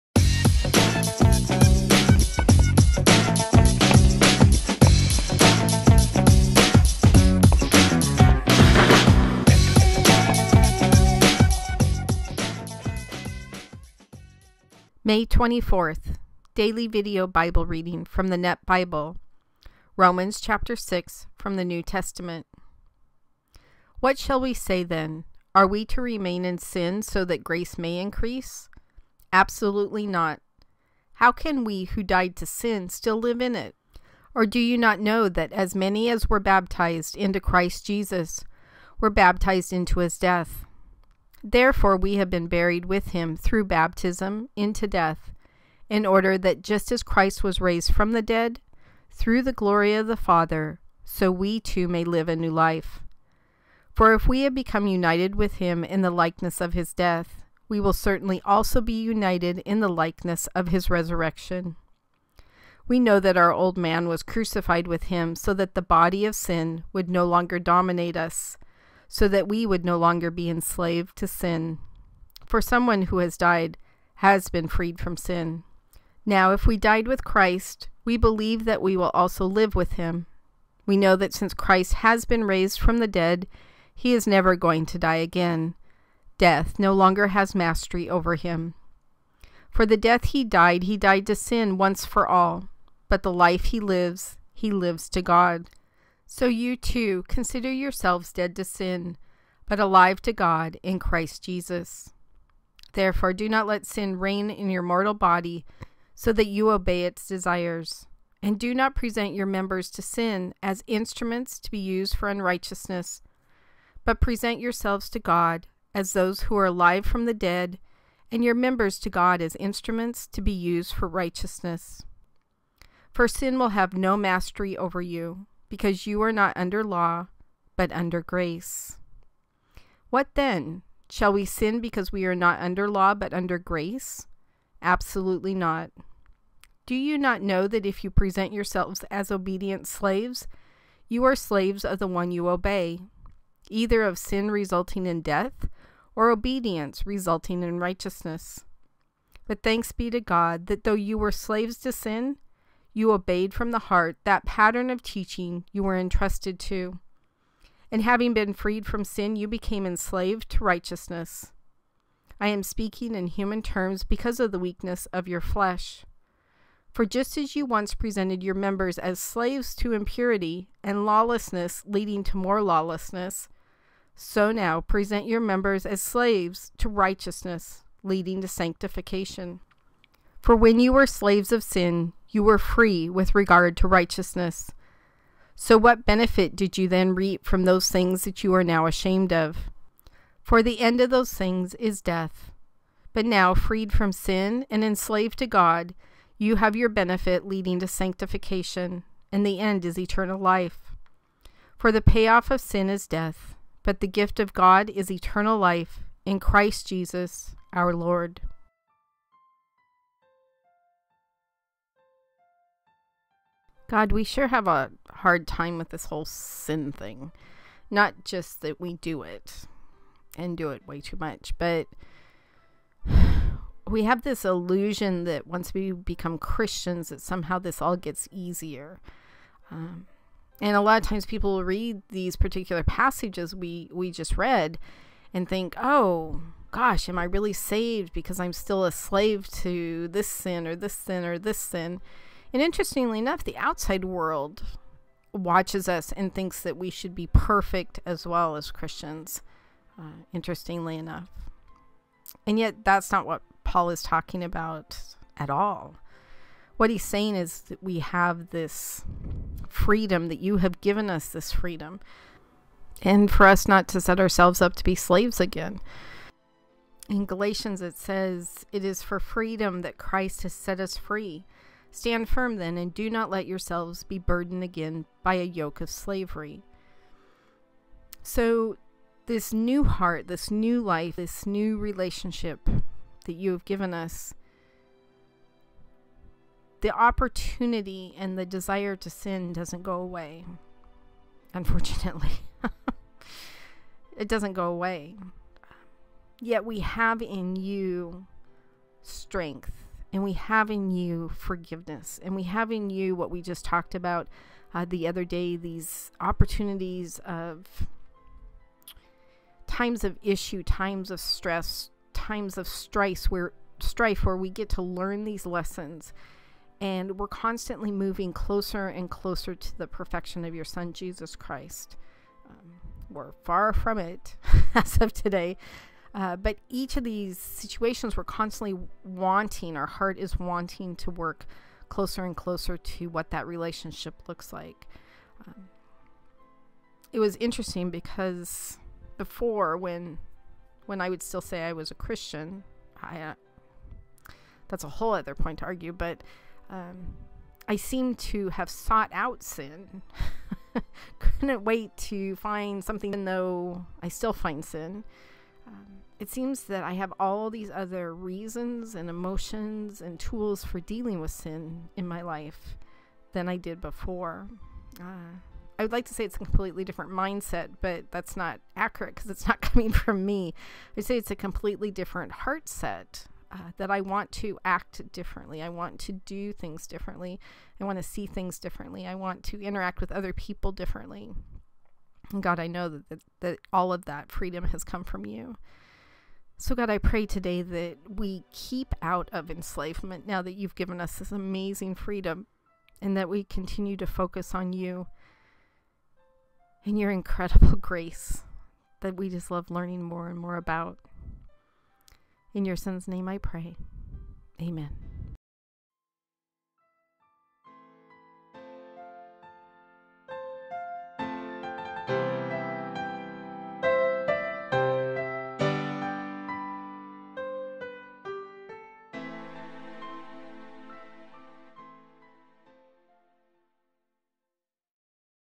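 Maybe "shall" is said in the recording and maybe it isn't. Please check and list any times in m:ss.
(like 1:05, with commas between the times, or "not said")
0:24, 2:11.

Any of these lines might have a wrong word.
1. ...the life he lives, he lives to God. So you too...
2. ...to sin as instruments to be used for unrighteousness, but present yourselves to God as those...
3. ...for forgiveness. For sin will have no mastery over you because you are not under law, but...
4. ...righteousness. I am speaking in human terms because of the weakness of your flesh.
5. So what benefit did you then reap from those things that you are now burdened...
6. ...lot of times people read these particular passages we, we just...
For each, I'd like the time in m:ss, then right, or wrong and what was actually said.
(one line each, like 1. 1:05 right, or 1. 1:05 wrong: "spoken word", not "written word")
1. 1:33 right
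2. 1:49 right
3. 2:00 wrong: "righteousness", not "forgiveness"
4. 2:40 right
5. 3:05 wrong: "ashamed", not "burdened"
6. 3:50 right.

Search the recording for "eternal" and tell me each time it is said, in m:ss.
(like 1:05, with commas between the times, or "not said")
3:19, 3:25.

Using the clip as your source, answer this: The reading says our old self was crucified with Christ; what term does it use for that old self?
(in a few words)
old man.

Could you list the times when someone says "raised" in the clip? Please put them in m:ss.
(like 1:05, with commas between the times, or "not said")
0:47, 1:22.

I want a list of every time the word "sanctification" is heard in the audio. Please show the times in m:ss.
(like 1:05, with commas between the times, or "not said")
2:58, 3:17.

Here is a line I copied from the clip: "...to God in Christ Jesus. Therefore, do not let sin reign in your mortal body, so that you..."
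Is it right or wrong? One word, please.
right.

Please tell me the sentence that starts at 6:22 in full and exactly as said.
And God, I know that, that, that all of that freedom has come from you.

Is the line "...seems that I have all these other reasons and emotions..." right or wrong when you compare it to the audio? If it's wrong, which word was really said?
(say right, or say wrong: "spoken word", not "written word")
right.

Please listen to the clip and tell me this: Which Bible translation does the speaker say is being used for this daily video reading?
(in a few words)
Net Bible.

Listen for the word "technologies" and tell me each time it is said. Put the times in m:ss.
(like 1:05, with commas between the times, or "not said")
not said.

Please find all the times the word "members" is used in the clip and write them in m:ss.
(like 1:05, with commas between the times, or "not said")
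1:49, 1:58, 2:48, 2:55.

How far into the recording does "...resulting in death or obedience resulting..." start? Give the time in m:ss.
2:24.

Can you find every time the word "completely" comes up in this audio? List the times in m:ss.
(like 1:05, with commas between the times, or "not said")
6:06, 6:11.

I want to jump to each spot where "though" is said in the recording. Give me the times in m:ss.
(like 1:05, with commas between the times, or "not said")
2:30, 5:53.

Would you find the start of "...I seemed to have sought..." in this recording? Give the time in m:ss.
5:47.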